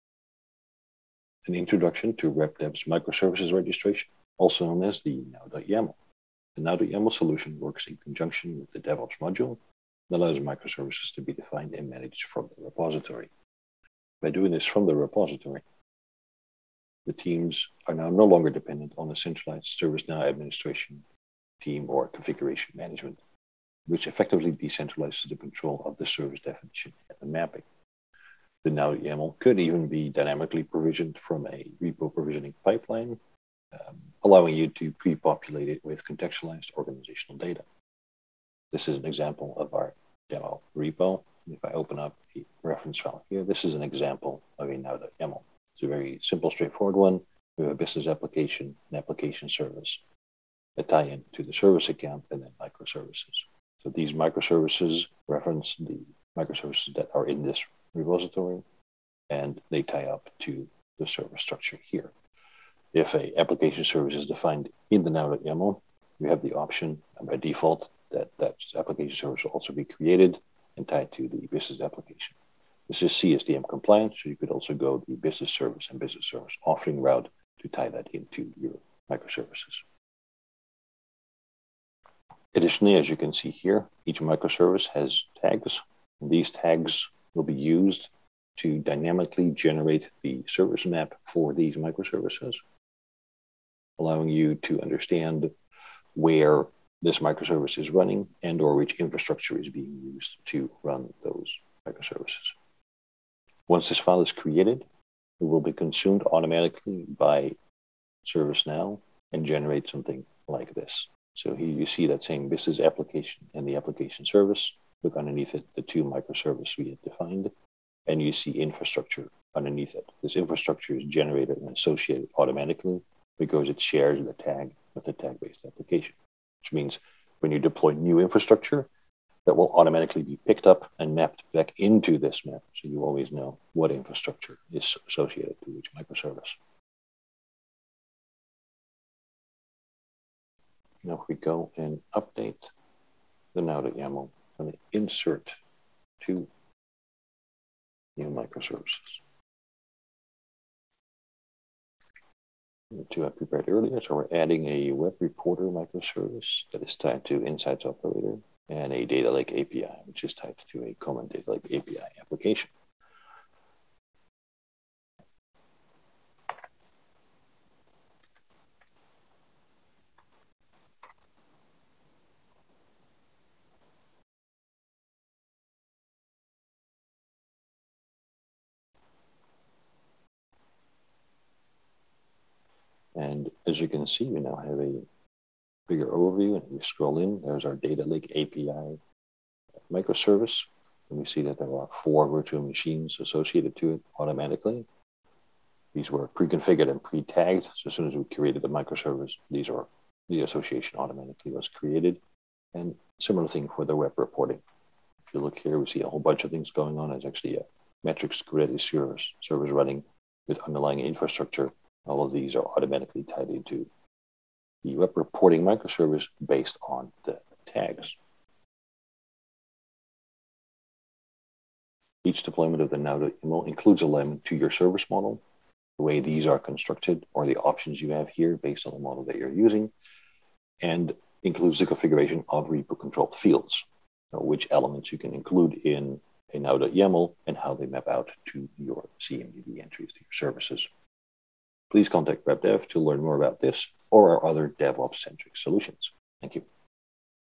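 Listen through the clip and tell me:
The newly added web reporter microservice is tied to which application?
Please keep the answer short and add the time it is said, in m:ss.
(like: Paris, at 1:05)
Insights Operator, at 2:37.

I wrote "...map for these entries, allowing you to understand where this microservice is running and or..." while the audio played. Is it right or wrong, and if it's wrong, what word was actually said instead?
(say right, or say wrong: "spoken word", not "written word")
wrong: "microservices", not "entries".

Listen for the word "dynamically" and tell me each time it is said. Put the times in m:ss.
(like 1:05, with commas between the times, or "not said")
0:30, 1:28.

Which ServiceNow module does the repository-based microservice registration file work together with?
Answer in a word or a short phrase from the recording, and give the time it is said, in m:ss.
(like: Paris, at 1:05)
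DevOps, at 0:08.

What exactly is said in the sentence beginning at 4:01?
Please contact RapDev to learn more about this or our other DevOps-centric solutions.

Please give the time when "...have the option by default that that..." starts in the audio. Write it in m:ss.
1:06.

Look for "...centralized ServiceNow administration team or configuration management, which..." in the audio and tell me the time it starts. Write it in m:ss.
0:19.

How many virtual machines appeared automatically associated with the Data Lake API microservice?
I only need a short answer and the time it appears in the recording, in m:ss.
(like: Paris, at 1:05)
4, at 3:12.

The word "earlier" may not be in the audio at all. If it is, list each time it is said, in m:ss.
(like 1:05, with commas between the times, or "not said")
2:33.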